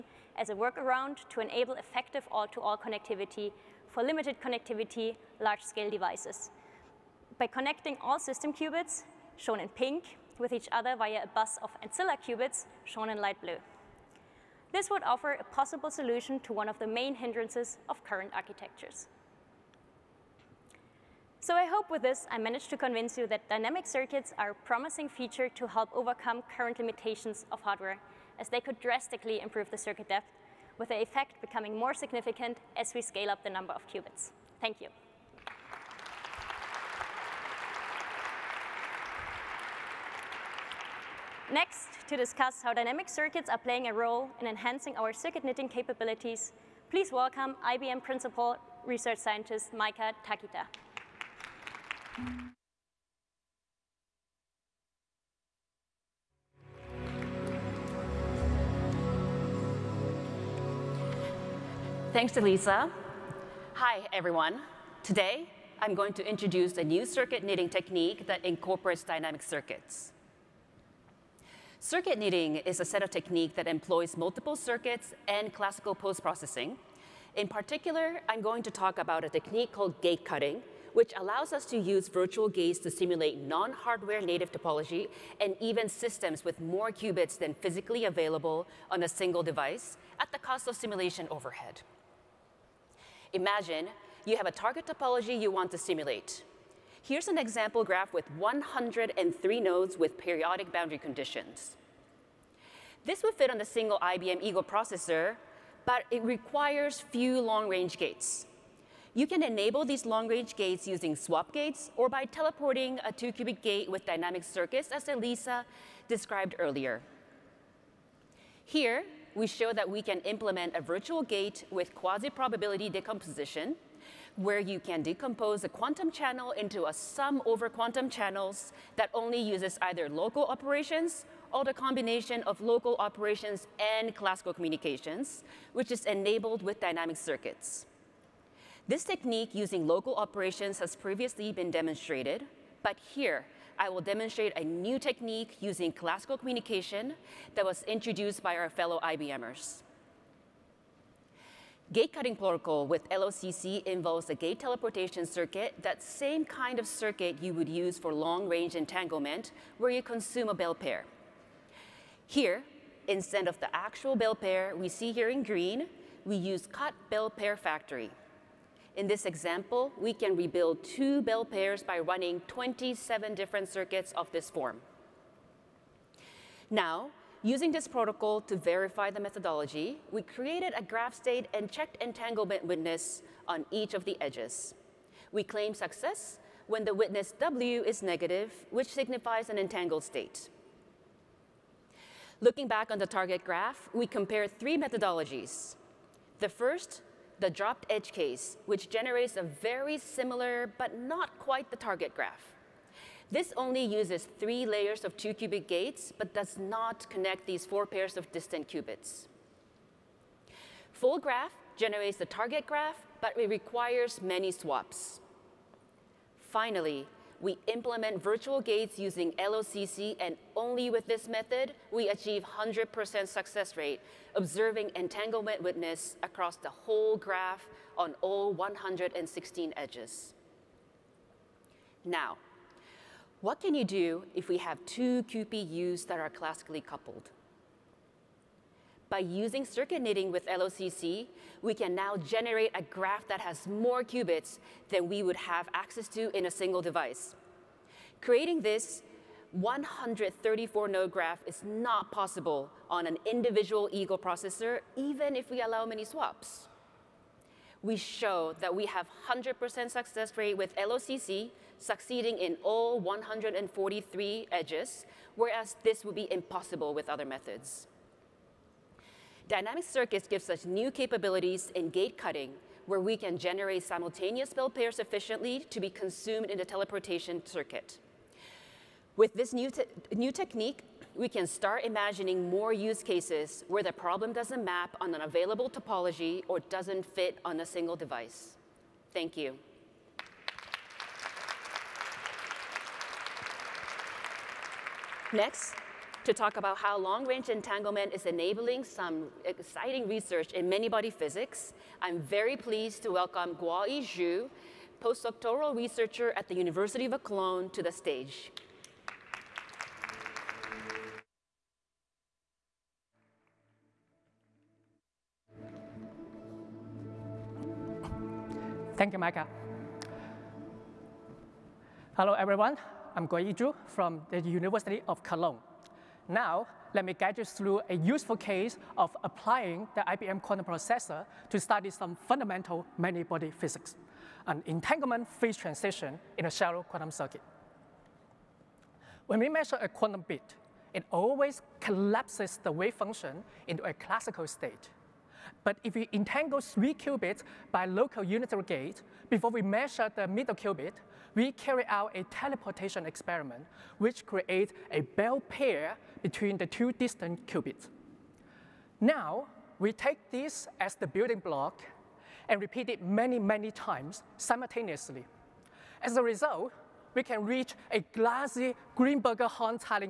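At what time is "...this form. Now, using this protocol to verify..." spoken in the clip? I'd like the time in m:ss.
2:54.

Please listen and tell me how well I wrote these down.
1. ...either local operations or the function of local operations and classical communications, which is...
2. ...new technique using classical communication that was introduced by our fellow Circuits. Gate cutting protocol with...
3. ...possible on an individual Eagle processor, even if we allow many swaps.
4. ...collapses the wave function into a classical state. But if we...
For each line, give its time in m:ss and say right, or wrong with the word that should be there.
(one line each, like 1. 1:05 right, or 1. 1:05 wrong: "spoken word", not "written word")
1. 2:09 wrong: "combination", not "function"
2. 2:24 wrong: "IBMers", not "Circuits"
3. 4:12 right
4. 5:41 right.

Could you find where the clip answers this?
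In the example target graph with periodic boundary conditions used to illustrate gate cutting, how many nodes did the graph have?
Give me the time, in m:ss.
1:38.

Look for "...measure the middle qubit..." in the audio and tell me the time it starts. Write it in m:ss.
5:49.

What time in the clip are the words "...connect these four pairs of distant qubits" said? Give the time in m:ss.
3:27.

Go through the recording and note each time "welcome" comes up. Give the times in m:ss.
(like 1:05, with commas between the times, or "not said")
0:47, 5:03.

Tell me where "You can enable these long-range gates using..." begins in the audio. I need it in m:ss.
1:49.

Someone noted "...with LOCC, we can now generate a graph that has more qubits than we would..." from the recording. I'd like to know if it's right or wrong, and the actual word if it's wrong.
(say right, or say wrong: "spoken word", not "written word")
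right.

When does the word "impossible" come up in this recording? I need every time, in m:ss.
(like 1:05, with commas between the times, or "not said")
4:26.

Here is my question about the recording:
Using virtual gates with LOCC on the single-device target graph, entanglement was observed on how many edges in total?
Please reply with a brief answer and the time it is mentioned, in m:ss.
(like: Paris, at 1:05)
116, at 3:48.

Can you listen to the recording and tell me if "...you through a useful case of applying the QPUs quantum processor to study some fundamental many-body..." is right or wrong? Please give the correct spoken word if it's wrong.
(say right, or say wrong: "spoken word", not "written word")
wrong: "IBM", not "QPUs".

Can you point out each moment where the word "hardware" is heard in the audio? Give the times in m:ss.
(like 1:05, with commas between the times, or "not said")
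0:27, 1:23.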